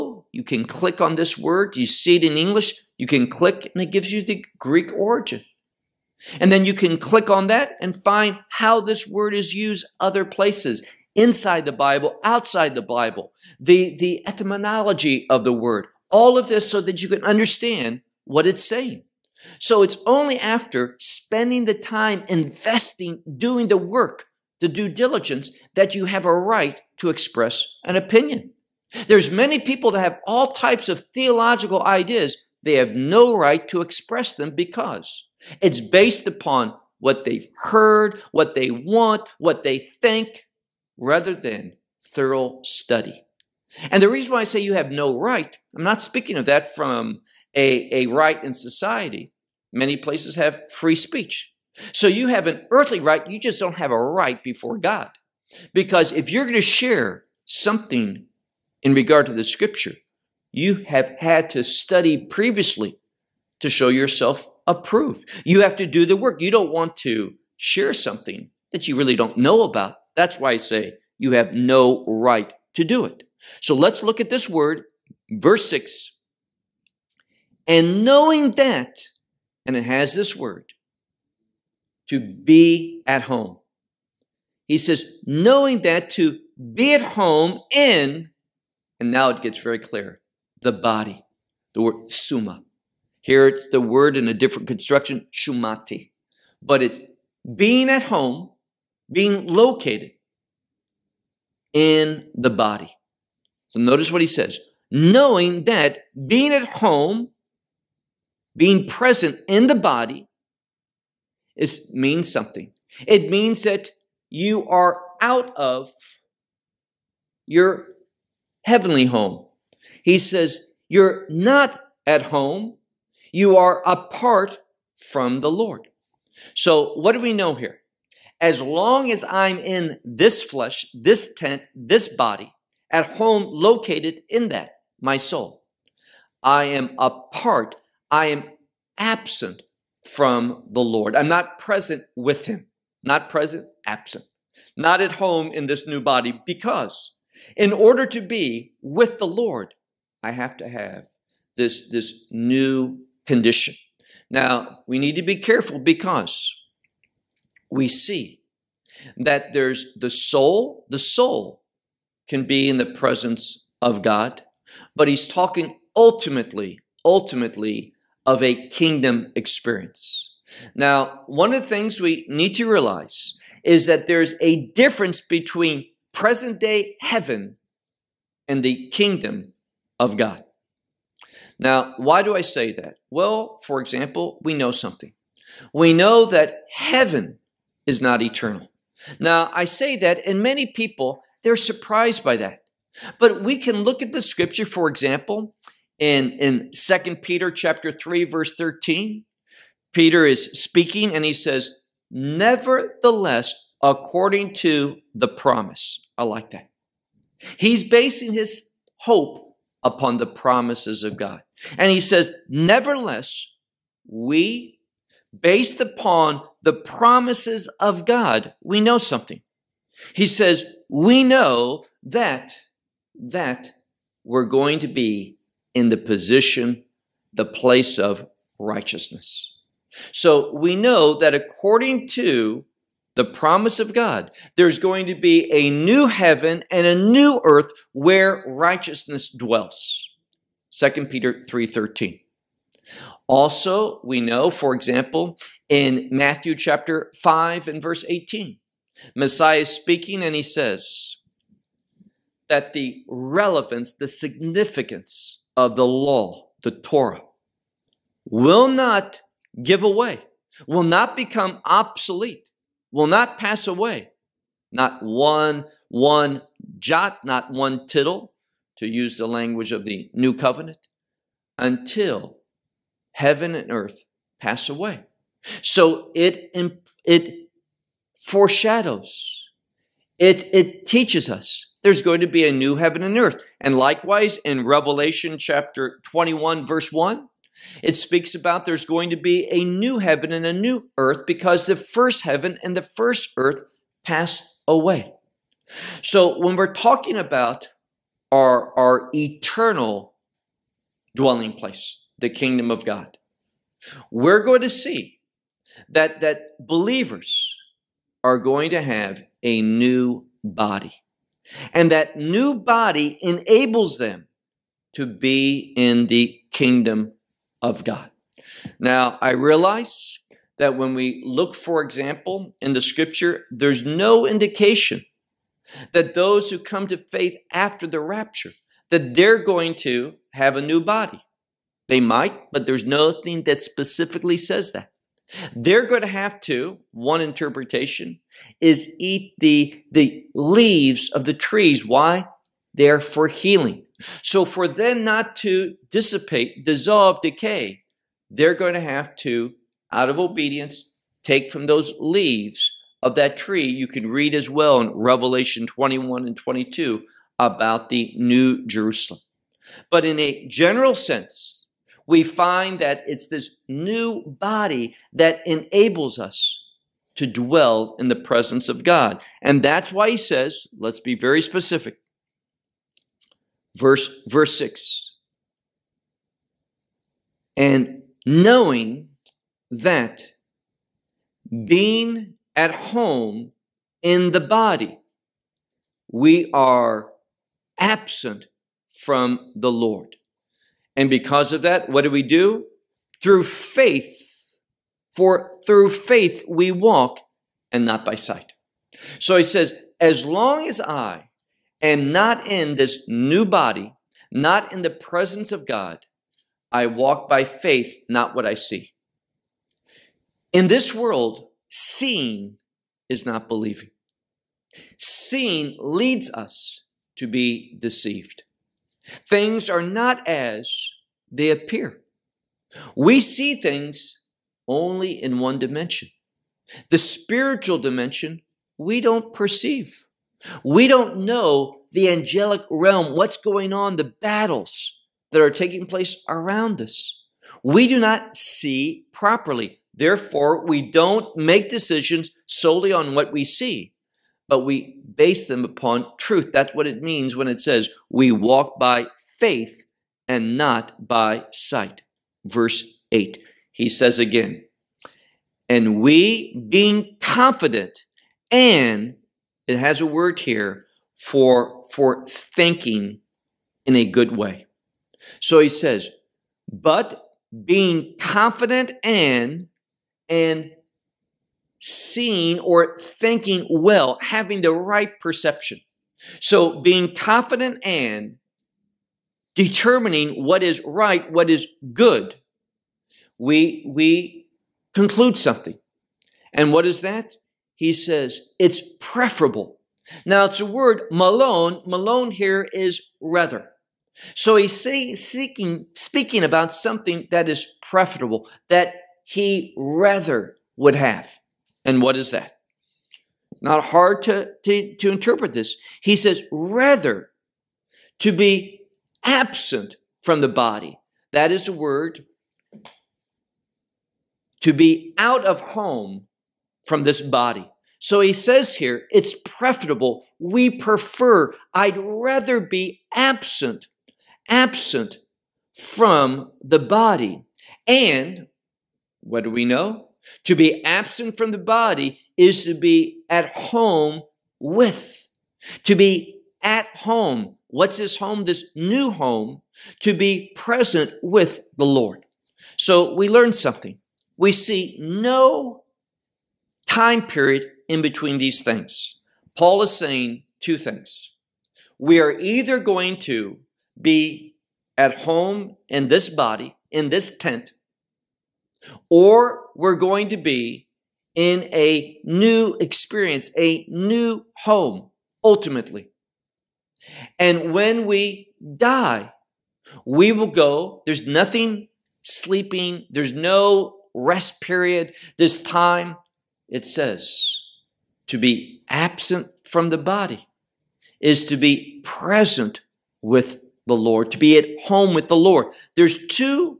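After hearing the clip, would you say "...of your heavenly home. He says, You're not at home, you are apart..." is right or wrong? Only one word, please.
right.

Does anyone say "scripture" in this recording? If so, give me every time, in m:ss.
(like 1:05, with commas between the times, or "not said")
0:59, 3:14, 5:22.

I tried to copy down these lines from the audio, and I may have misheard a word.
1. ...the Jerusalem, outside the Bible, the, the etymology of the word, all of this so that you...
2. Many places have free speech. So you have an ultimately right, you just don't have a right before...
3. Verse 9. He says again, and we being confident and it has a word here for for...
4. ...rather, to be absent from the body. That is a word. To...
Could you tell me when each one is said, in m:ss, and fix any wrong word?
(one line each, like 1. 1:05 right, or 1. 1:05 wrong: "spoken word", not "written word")
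1. 0:11 wrong: "Bible", not "Jerusalem"
2. 0:49 wrong: "earthly", not "ultimately"
3. 7:32 wrong: "8", not "9"
4. 8:26 right.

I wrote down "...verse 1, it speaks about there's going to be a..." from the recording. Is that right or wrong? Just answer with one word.
right.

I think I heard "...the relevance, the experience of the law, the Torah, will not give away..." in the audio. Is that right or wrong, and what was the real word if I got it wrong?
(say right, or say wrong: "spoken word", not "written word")
wrong: "significance", not "experience".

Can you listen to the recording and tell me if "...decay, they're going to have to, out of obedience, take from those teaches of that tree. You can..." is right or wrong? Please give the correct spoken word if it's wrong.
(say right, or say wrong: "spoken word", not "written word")
wrong: "leaves", not "teaches".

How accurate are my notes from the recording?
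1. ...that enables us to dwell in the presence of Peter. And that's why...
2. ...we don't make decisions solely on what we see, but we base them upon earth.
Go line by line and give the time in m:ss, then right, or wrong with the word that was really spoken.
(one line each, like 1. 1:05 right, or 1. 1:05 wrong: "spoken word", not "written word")
1. 6:05 wrong: "God", not "Peter"
2. 7:20 wrong: "truth", not "earth".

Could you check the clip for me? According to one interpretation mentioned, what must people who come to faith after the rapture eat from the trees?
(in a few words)
The leaves.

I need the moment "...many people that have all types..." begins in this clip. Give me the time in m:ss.
0:29.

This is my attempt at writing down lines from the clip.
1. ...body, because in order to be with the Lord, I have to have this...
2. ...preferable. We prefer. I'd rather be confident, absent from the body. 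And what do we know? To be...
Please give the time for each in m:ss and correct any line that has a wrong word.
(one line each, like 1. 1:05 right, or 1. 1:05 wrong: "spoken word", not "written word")
1. 2:26 right
2. 8:39 wrong: "absent", not "confident".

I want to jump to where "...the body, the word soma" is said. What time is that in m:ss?
1:30.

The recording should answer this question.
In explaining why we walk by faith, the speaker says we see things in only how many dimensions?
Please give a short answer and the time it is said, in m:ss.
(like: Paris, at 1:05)
1, at 7:05.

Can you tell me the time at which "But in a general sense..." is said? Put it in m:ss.
5:59.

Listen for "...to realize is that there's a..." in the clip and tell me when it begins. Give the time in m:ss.
2:52.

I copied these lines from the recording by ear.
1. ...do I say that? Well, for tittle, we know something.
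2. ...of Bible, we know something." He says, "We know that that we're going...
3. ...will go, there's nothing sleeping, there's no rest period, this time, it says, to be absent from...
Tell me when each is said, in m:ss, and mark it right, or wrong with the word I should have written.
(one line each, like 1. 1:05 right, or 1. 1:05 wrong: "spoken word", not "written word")
1. 3:02 wrong: "example", not "tittle"
2. 3:37 wrong: "God", not "Bible"
3. 9:30 right.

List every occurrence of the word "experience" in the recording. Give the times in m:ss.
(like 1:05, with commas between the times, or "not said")
2:49, 9:22.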